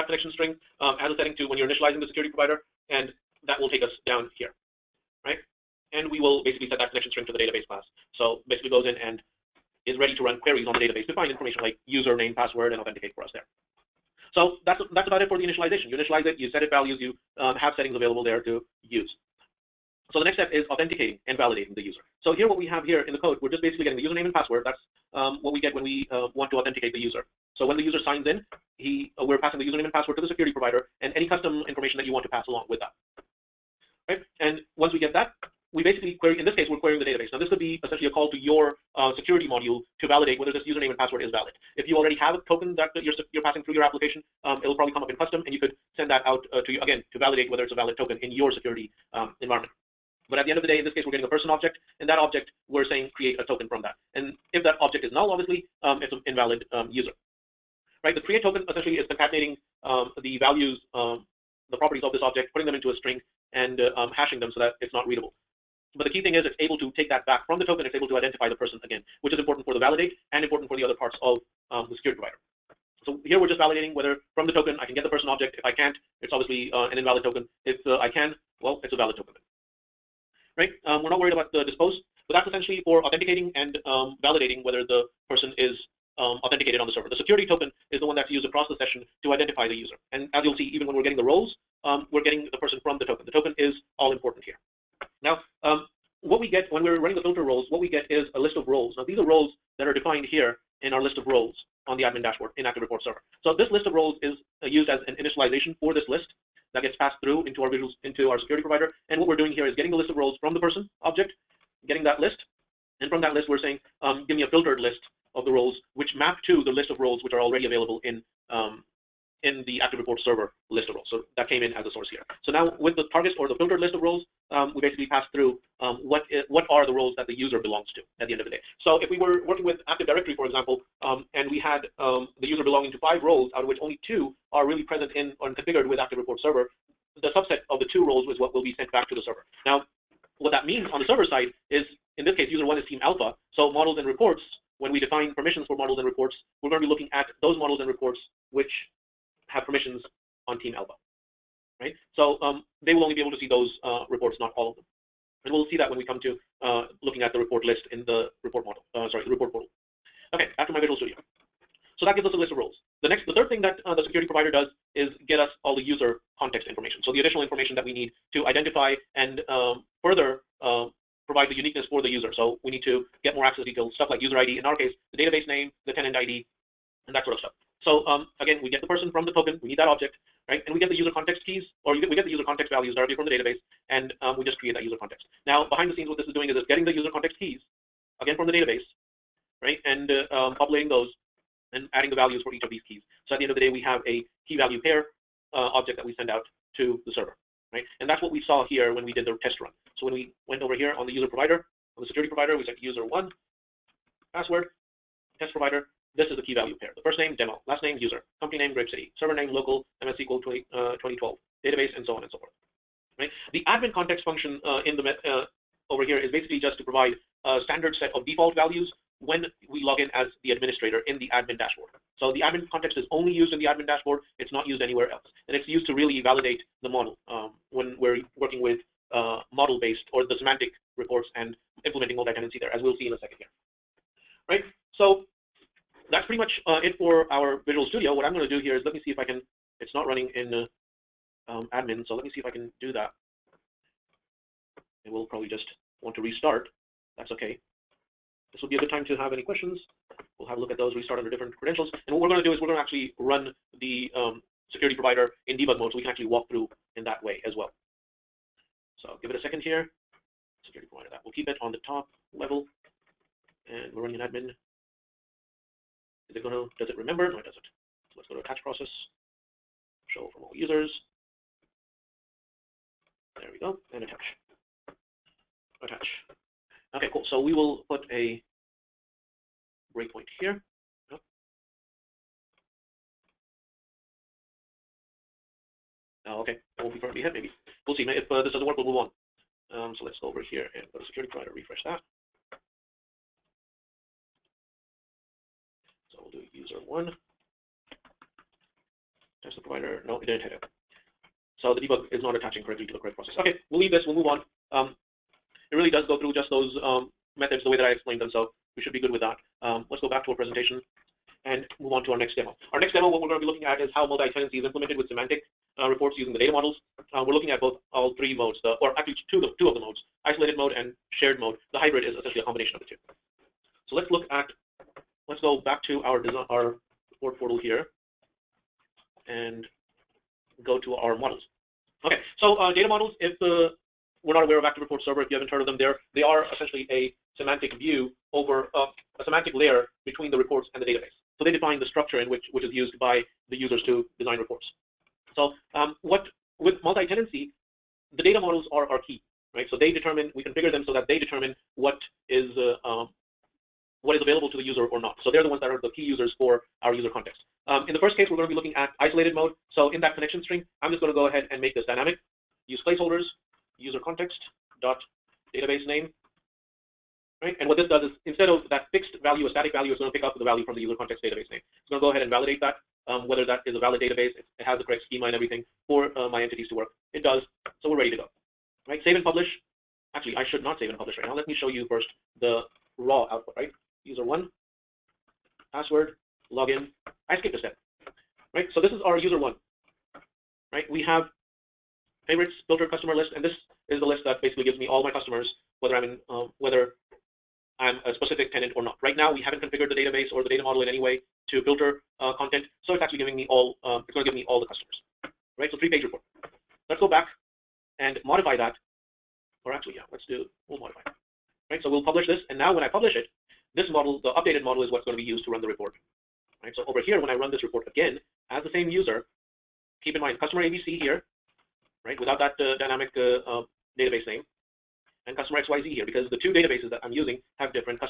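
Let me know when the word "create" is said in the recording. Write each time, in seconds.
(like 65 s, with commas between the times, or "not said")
53 s, 58 s, 184 s.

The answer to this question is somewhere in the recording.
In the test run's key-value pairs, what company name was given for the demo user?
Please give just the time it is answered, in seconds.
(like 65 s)
208 s.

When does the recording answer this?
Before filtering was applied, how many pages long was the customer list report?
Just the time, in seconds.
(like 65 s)
405 s.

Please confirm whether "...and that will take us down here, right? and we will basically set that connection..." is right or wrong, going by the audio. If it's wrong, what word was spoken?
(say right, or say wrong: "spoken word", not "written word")
right.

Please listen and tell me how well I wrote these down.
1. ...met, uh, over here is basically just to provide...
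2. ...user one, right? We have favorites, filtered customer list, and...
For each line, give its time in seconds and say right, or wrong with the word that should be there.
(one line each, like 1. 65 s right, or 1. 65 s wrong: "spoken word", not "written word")
1. 215 s right
2. 389 s right.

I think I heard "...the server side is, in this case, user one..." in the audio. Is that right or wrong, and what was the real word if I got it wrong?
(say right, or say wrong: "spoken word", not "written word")
right.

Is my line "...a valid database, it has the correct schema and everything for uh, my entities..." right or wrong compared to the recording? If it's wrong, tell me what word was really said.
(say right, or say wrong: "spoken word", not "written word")
right.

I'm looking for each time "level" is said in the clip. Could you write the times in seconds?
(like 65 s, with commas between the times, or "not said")
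262 s.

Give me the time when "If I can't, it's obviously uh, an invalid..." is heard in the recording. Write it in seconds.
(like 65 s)
75 s.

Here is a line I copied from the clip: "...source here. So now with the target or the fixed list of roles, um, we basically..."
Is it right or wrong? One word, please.
wrong.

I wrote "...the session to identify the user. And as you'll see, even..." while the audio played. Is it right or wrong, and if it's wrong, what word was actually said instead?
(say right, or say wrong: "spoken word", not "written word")
right.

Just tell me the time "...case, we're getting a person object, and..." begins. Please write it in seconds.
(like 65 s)
50 s.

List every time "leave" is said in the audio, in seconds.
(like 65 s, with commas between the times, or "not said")
303 s.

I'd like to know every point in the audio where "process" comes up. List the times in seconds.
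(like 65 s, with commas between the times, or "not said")
268 s, 303 s.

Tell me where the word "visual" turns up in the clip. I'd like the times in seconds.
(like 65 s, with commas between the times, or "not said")
107 s, 160 s, 237 s.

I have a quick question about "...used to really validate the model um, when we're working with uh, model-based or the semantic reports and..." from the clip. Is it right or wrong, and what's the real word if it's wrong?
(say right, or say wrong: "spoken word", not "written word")
right.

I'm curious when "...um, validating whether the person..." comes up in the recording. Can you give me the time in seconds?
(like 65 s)
83 s.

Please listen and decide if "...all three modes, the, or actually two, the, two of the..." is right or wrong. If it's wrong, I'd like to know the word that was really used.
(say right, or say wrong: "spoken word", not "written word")
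right.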